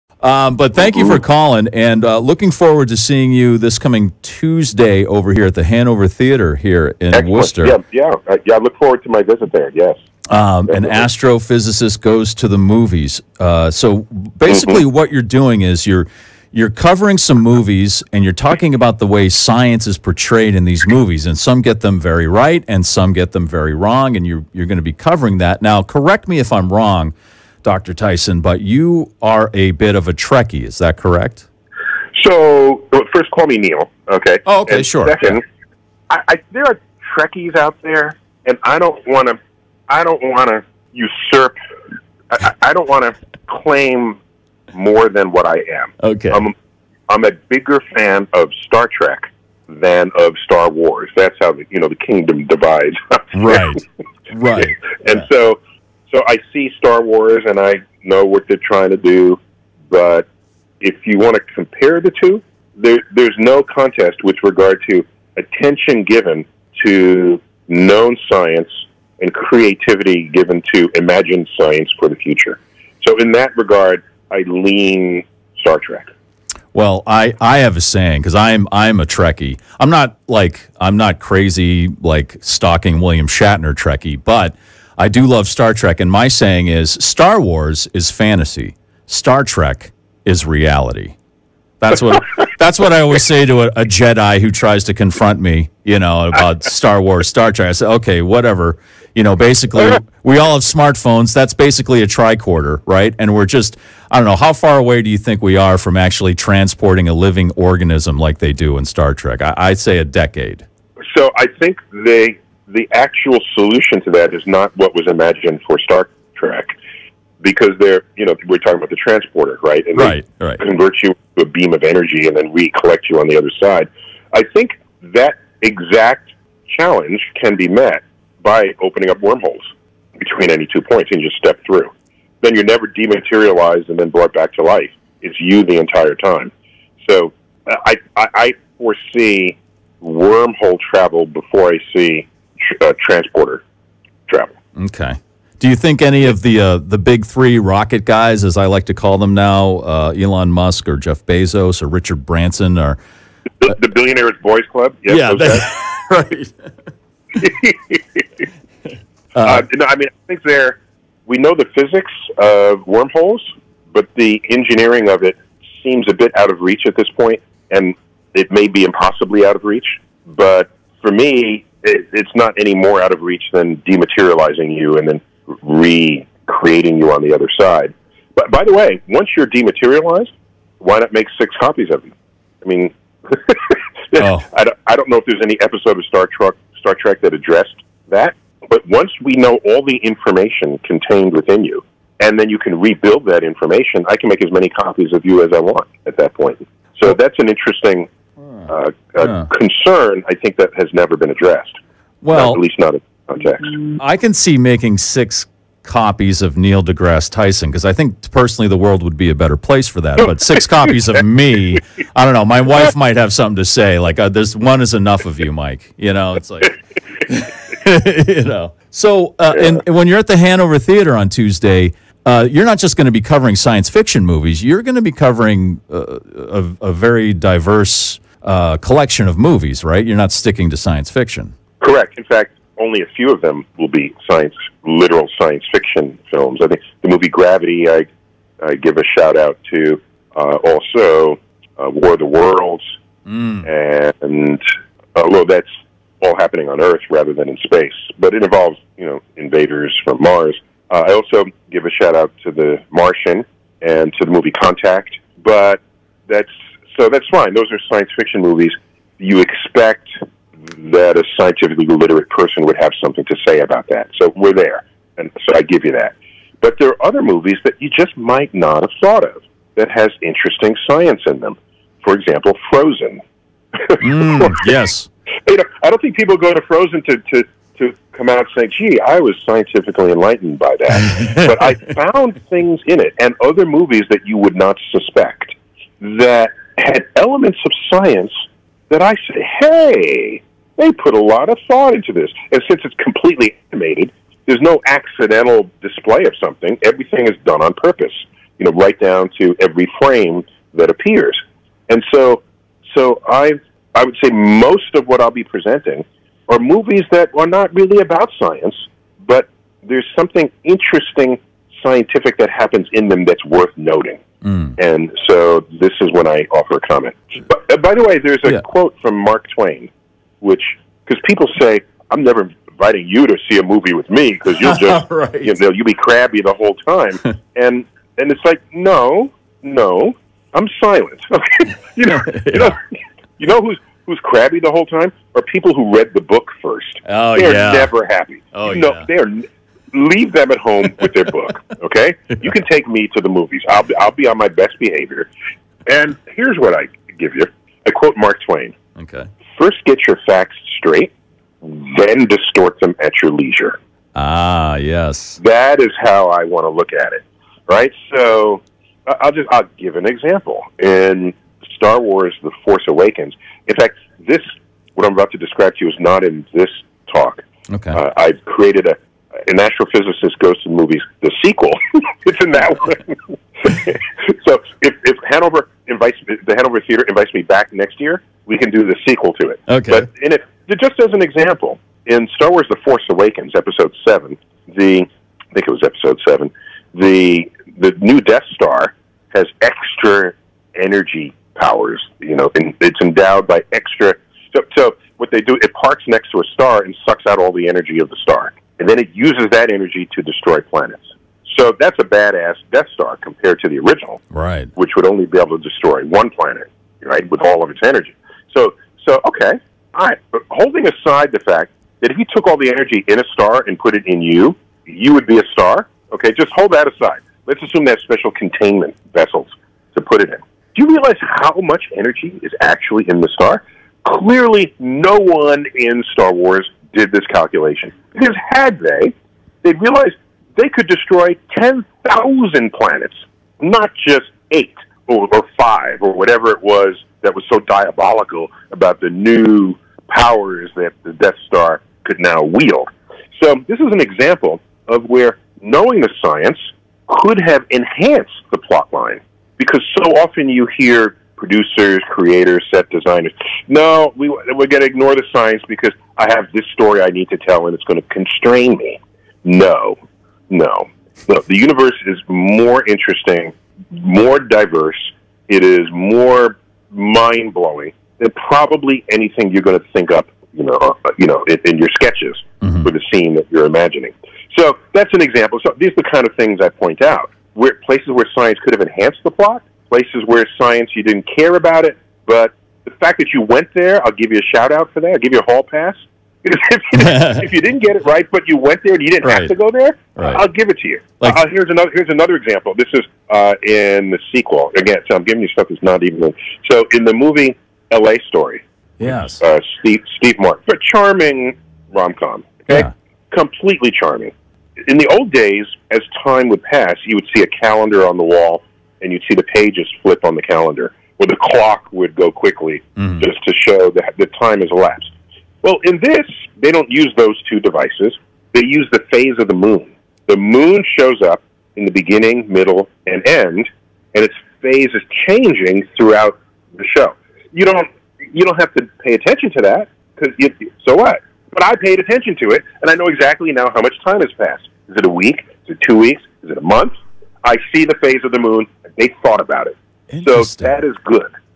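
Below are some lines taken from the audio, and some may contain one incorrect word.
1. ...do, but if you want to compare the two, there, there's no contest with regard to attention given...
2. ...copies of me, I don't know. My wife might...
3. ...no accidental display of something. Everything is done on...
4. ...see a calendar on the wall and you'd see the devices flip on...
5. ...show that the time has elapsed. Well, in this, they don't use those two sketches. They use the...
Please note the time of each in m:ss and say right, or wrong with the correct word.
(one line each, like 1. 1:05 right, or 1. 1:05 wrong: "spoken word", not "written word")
1. 0:58 right
2. 3:30 right
3. 4:54 right
4. 8:27 wrong: "pages", not "devices"
5. 8:33 wrong: "devices", not "sketches".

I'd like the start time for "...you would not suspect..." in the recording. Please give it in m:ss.
4:44.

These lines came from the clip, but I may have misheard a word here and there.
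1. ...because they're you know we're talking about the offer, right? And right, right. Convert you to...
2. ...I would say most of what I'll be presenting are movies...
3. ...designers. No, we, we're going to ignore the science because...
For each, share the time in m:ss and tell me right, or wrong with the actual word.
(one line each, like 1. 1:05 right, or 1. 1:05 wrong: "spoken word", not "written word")
1. 1:57 wrong: "transporter", not "offer"
2. 5:03 right
3. 7:32 right.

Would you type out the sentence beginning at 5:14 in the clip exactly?
And so this is when I offer a comment.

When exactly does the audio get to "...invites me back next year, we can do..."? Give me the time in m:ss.
6:17.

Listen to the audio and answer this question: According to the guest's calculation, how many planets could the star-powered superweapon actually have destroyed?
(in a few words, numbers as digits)
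10,000.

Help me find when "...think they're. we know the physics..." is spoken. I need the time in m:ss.
2:40.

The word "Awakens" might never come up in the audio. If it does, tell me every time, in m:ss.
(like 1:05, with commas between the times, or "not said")
6:02, 6:23.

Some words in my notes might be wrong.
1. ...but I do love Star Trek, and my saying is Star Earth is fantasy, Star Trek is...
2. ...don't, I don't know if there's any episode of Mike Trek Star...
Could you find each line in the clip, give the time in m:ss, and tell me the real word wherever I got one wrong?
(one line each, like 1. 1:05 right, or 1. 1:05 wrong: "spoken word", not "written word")
1. 1:24 wrong: "Wars", not "Earth"
2. 3:04 wrong: "Star", not "Mike".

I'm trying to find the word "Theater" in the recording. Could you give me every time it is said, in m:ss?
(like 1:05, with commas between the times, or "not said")
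0:06, 3:40, 6:16.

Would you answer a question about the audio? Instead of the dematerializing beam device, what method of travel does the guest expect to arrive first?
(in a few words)
wormhole travel.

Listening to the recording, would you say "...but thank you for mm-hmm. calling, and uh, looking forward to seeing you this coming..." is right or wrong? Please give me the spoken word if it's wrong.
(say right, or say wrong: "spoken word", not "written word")
right.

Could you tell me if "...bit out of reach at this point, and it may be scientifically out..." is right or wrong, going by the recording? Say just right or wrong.
wrong.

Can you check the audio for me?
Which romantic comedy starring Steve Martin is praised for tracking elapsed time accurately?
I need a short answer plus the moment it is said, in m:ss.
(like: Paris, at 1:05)
L.A. Story, at 8:17.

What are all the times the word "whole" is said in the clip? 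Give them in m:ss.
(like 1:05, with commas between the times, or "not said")
5:26, 5:34.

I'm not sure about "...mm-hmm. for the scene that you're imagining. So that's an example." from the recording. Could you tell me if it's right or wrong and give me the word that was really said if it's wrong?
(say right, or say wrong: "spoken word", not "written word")
right.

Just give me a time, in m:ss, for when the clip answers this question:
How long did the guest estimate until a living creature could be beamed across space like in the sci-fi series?
1:49.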